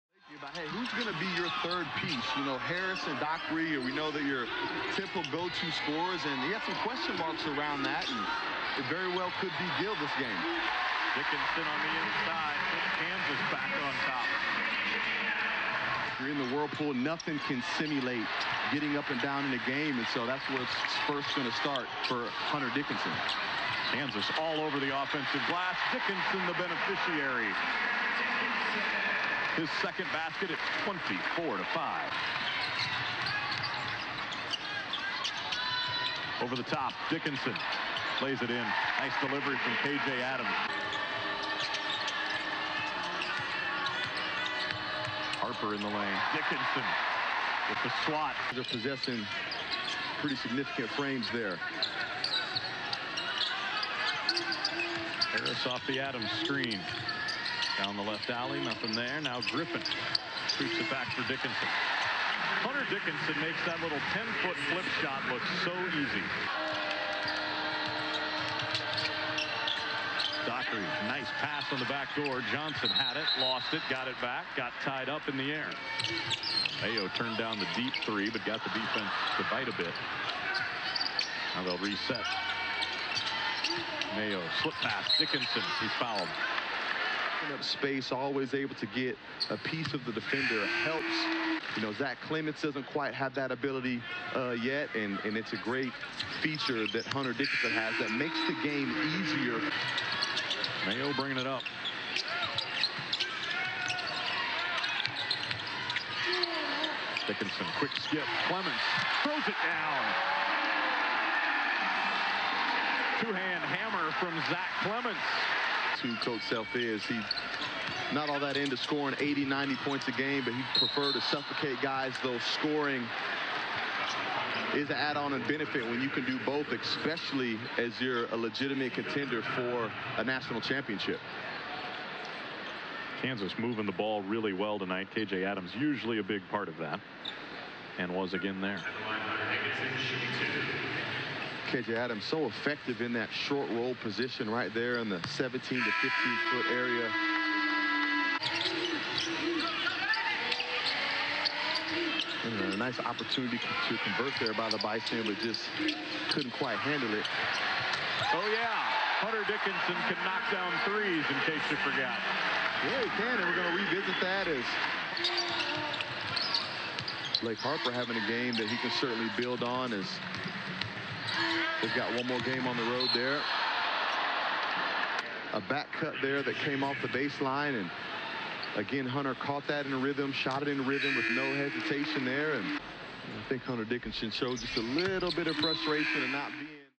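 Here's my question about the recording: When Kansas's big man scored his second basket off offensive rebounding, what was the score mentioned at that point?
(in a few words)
24 to 5.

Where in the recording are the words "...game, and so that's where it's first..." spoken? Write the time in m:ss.
0:19.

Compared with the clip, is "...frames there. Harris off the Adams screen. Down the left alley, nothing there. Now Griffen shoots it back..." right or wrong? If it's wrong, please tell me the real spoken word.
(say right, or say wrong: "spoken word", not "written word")
right.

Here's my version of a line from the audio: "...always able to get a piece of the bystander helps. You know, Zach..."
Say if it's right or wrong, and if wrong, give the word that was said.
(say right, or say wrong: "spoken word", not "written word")
wrong: "defender", not "bystander".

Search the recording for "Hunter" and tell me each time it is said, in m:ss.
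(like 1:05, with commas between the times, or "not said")
0:22, 1:02, 1:37, 2:39, 2:59, 3:03.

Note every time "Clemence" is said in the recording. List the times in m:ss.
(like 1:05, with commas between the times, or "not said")
1:32, 1:48, 1:54.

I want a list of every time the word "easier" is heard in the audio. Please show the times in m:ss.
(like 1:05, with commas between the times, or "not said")
1:39.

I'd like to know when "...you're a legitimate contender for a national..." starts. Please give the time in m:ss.
2:08.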